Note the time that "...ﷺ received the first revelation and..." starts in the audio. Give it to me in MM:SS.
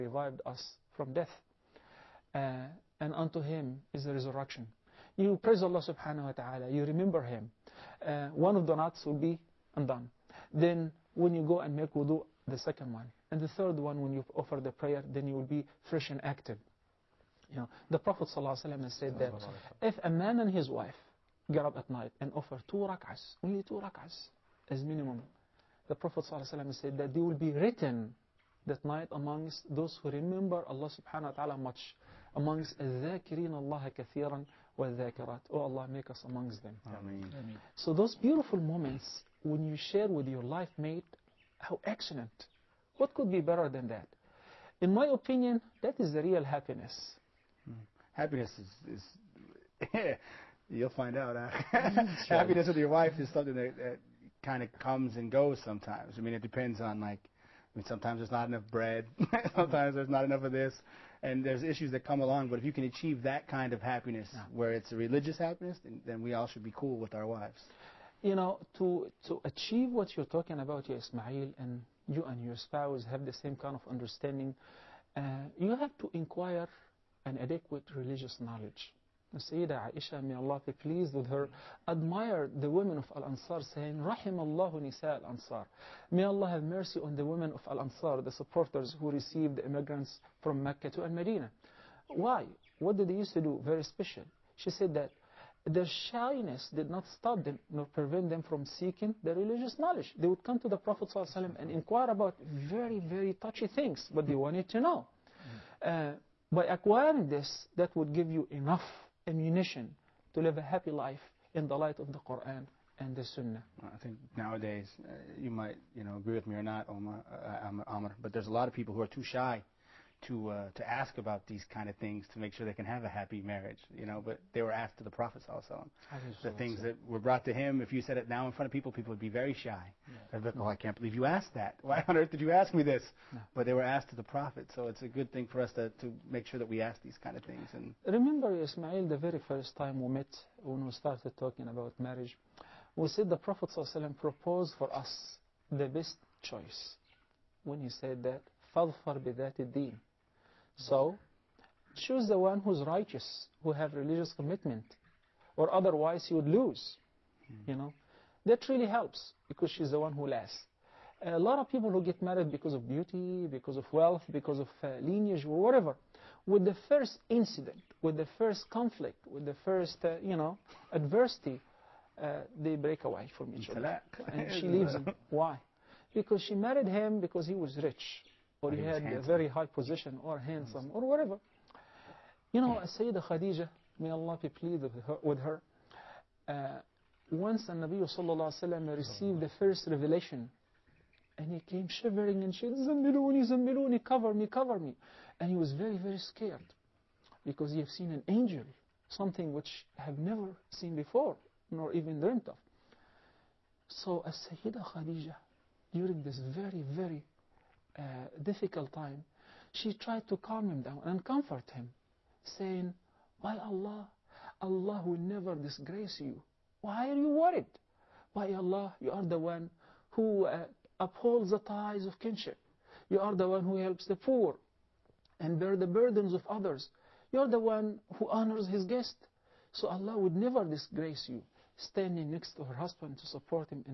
03:08.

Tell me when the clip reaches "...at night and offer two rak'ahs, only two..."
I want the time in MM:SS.
00:21.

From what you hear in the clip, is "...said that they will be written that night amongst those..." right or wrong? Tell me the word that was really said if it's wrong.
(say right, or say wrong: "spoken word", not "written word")
right.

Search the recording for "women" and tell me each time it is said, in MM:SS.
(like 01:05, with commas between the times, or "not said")
01:22, 01:27.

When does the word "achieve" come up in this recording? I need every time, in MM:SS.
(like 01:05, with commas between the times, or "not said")
01:02, 01:09.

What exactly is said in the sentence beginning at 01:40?
They would come to the Prophet ﷺ and inquire about very, very touchy things, but they wanted to know.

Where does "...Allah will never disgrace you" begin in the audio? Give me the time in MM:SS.
03:34.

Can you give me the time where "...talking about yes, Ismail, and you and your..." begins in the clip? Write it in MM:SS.
01:10.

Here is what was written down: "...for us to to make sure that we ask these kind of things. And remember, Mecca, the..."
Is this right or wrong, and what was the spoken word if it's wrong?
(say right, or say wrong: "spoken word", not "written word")
wrong: "Ismail", not "Mecca".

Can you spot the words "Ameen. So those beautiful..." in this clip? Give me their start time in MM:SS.
00:37.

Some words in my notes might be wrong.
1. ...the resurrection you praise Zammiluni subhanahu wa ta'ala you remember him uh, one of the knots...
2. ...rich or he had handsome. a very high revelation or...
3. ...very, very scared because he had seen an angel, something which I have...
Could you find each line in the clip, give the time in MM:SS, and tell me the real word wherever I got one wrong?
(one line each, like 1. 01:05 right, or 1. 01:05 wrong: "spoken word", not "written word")
1. 00:04 wrong: "Allah", not "Zammiluni"
2. 02:57 wrong: "position", not "revelation"
3. 03:15 right.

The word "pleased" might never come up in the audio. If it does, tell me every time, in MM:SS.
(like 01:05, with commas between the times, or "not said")
01:20, 03:04.